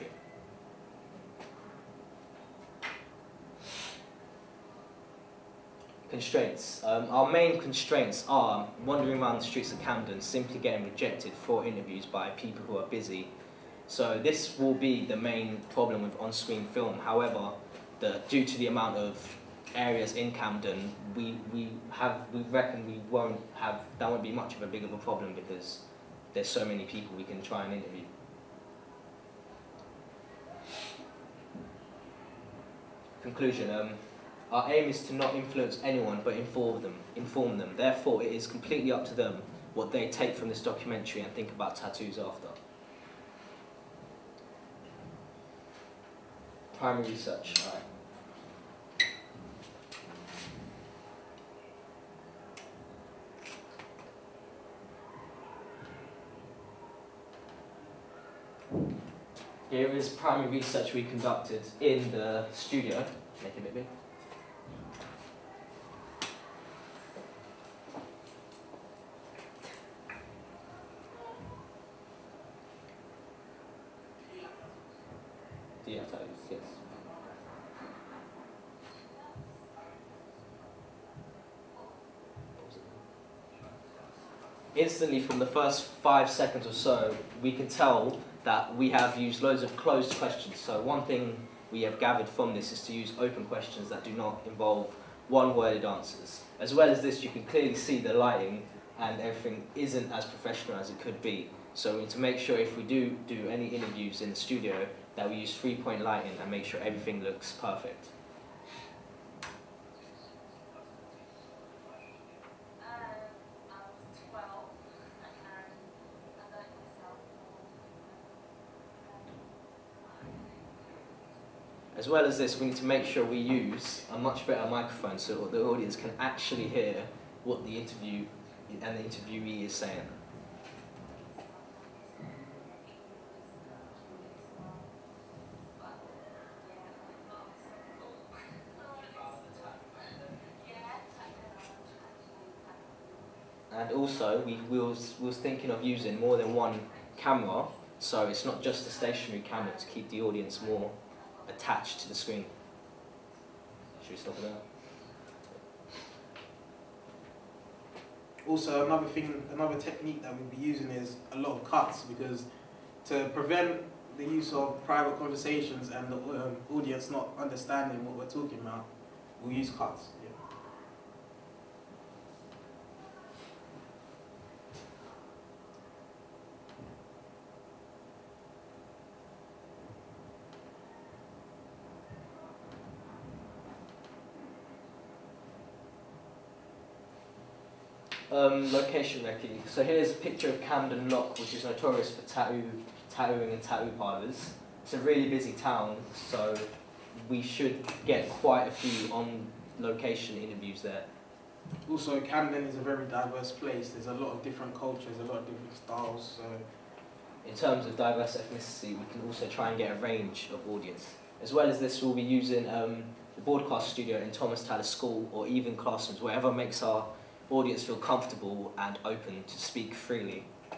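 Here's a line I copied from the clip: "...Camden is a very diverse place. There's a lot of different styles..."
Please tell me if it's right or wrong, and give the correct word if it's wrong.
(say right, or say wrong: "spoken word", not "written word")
wrong: "cultures", not "styles".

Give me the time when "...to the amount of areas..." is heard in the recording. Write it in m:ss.
0:18.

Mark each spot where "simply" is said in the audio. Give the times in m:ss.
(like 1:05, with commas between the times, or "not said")
0:10.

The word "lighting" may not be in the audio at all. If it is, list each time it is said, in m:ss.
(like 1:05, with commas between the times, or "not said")
1:38, 1:46.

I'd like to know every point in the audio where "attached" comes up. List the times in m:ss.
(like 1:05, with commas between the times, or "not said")
2:31.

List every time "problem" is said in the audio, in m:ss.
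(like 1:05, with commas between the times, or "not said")
0:15, 0:24.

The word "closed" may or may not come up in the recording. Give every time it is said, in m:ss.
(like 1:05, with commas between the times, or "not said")
1:29.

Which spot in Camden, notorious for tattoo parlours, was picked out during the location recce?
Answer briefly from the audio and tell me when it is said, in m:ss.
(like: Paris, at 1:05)
Camden Lock, at 3:10.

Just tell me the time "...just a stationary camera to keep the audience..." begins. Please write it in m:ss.
2:28.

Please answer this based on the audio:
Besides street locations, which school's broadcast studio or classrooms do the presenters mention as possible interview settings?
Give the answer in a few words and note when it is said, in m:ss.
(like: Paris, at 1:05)
Thomas Tallis School, at 3:34.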